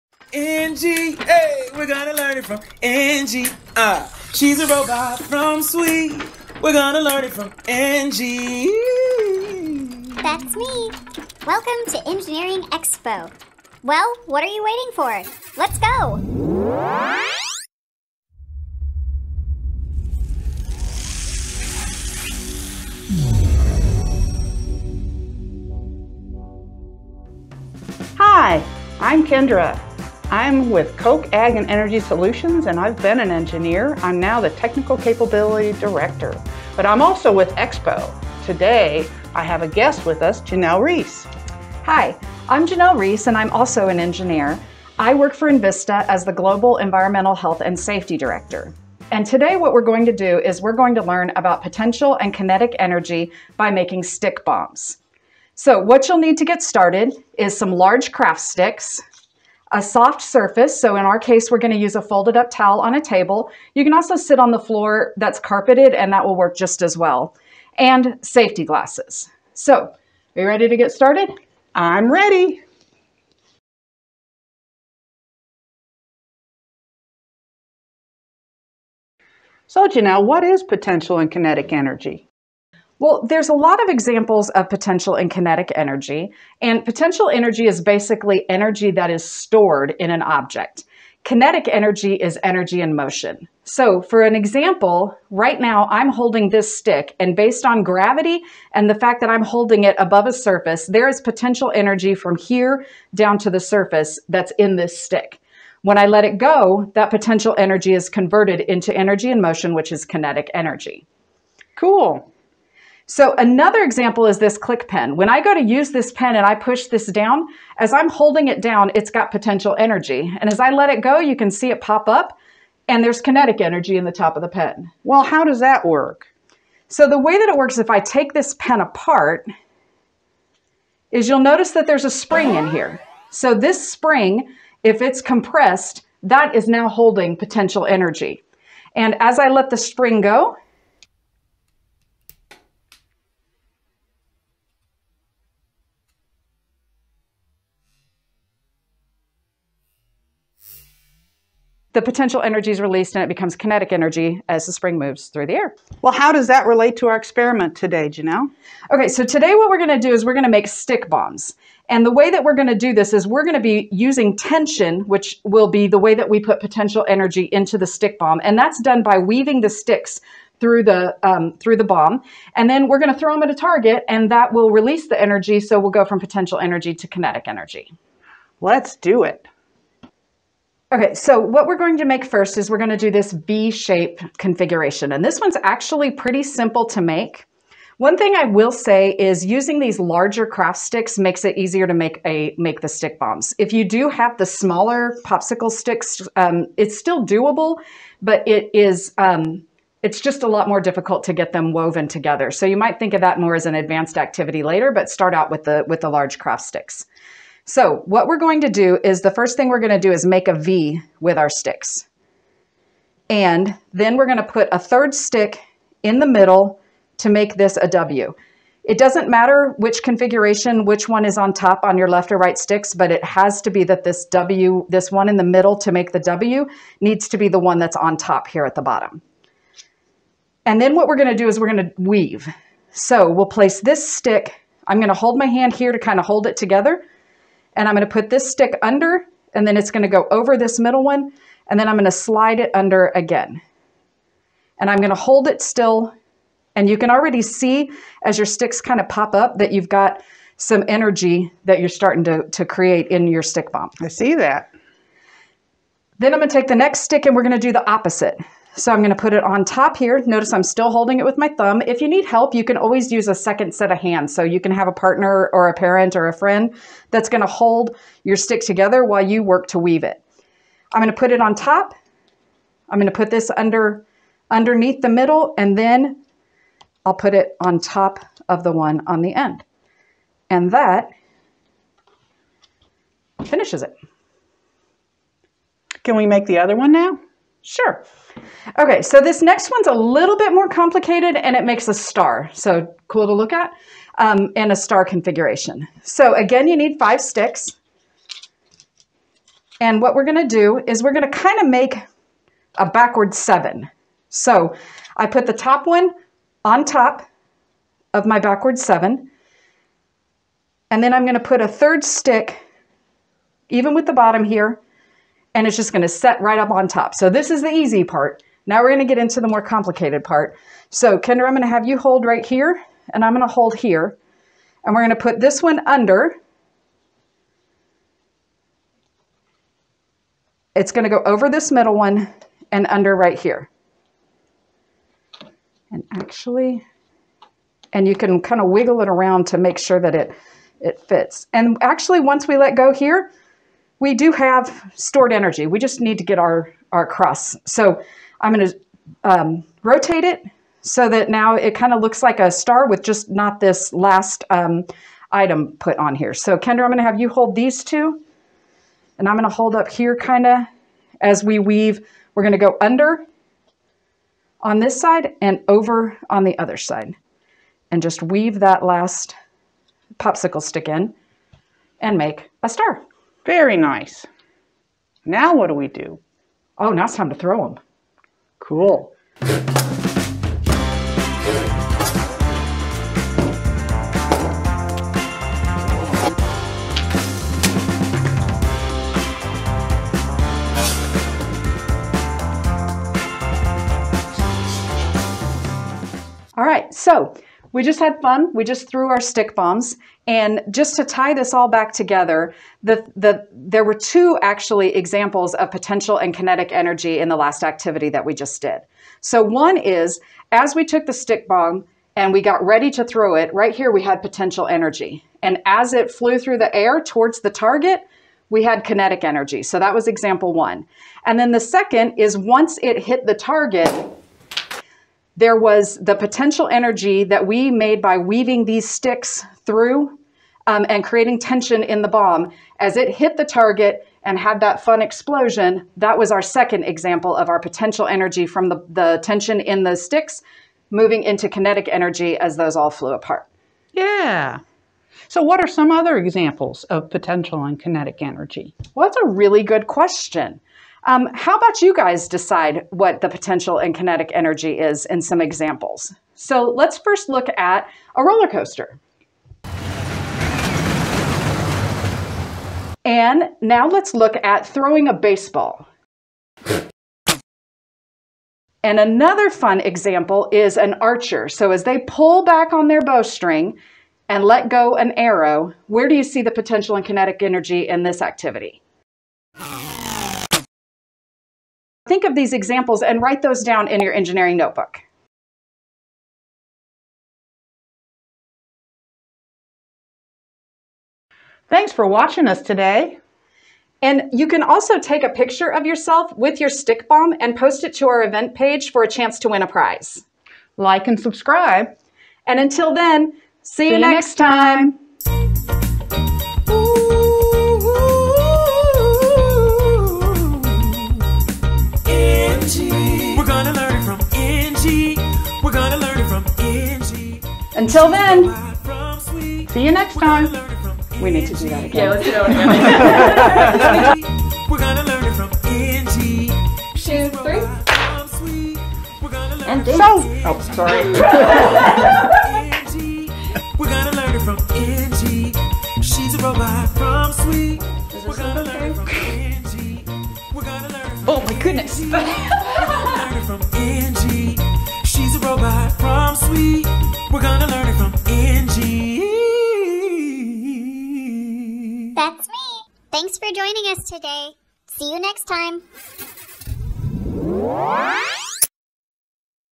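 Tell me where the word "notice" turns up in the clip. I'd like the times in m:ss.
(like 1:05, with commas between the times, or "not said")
2:11, 4:20.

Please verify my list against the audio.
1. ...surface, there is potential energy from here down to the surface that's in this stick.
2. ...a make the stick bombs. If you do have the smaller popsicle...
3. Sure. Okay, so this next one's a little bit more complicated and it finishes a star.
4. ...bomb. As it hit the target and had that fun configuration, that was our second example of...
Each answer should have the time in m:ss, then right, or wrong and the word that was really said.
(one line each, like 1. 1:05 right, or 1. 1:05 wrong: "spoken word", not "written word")
1. 1:40 right
2. 3:12 right
3. 4:47 wrong: "makes", not "finishes"
4. 7:12 wrong: "explosion", not "configuration".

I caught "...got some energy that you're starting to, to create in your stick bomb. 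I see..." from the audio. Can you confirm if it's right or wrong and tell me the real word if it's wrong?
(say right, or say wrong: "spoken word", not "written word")
right.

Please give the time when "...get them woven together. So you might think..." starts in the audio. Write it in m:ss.
3:21.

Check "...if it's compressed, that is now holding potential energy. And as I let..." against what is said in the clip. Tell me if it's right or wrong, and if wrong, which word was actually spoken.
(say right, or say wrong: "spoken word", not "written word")
right.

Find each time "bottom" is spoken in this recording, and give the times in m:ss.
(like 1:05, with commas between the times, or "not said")
3:48, 5:14.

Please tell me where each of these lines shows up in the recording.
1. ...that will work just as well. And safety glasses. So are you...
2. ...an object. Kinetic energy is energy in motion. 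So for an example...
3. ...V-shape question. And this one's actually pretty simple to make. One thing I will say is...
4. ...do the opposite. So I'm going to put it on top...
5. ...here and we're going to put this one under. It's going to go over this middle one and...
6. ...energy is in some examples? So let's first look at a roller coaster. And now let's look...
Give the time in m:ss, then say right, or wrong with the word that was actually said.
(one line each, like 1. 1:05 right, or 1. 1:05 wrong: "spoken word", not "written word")
1. 1:06 right
2. 1:30 right
3. 3:03 wrong: "configuration", not "question"
4. 4:17 right
5. 5:23 right
6. 7:34 right.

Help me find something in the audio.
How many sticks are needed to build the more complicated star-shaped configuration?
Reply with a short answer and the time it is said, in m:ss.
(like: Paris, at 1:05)
five, at 4:56.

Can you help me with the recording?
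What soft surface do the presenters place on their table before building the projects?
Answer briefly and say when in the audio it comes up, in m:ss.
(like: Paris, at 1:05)
folded up towel, at 1:02.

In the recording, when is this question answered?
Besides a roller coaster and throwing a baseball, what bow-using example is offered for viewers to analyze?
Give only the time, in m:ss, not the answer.
7:50.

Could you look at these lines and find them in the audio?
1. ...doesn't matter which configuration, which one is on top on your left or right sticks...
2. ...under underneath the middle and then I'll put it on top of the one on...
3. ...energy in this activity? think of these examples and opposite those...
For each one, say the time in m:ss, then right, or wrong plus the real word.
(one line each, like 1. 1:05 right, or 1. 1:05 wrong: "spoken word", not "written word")
1. 3:38 right
2. 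4:33 right
3. 7:57 wrong: "write", not "opposite".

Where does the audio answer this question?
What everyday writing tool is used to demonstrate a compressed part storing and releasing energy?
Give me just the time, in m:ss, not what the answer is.
1:54.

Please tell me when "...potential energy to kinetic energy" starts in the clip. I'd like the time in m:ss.
2:56.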